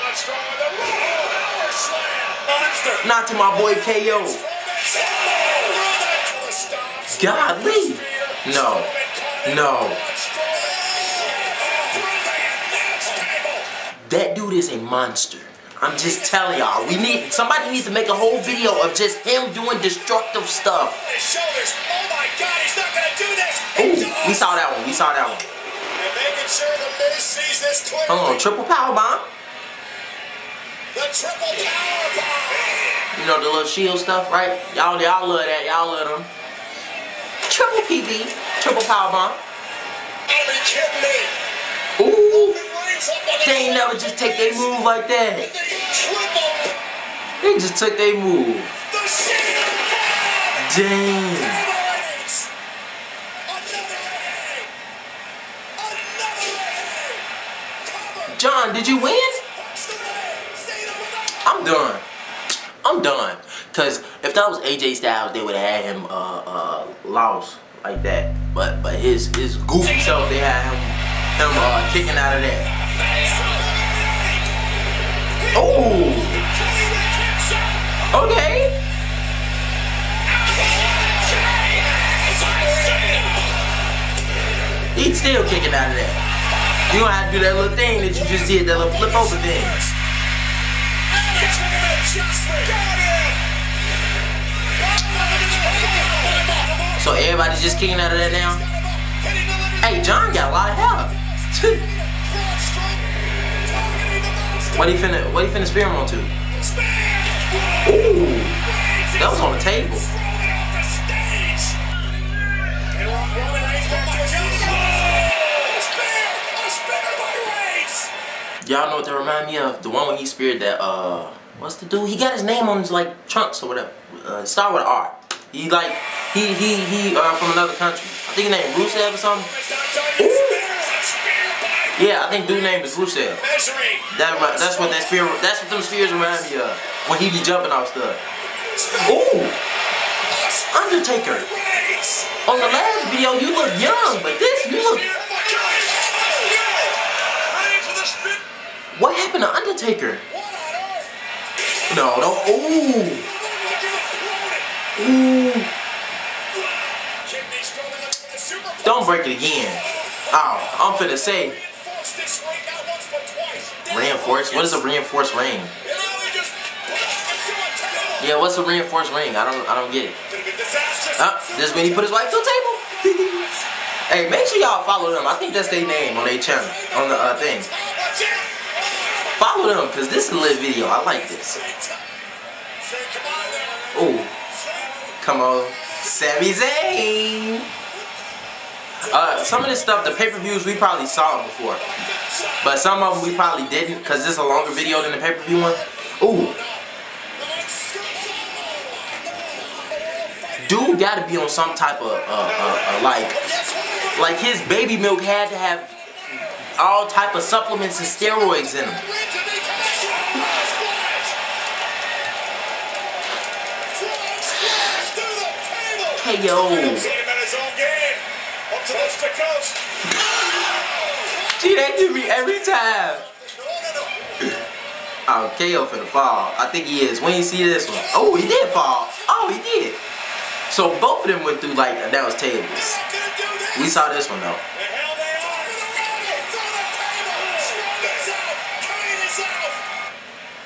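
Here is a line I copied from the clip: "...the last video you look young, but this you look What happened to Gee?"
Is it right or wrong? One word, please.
wrong.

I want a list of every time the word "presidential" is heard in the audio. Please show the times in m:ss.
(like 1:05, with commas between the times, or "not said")
not said.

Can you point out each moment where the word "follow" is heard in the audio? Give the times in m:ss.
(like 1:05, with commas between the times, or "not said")
2:54, 2:59.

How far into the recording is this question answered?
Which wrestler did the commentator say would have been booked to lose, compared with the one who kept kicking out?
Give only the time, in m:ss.
1:04.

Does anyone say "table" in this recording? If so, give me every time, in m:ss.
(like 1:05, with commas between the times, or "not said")
1:49, 2:52, 3:52.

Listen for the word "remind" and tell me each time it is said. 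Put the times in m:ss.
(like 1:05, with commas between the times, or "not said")
1:59, 2:16.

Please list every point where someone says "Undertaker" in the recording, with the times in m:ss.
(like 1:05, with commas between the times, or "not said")
2:20, 2:29.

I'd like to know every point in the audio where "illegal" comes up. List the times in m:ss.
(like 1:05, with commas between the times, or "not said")
not said.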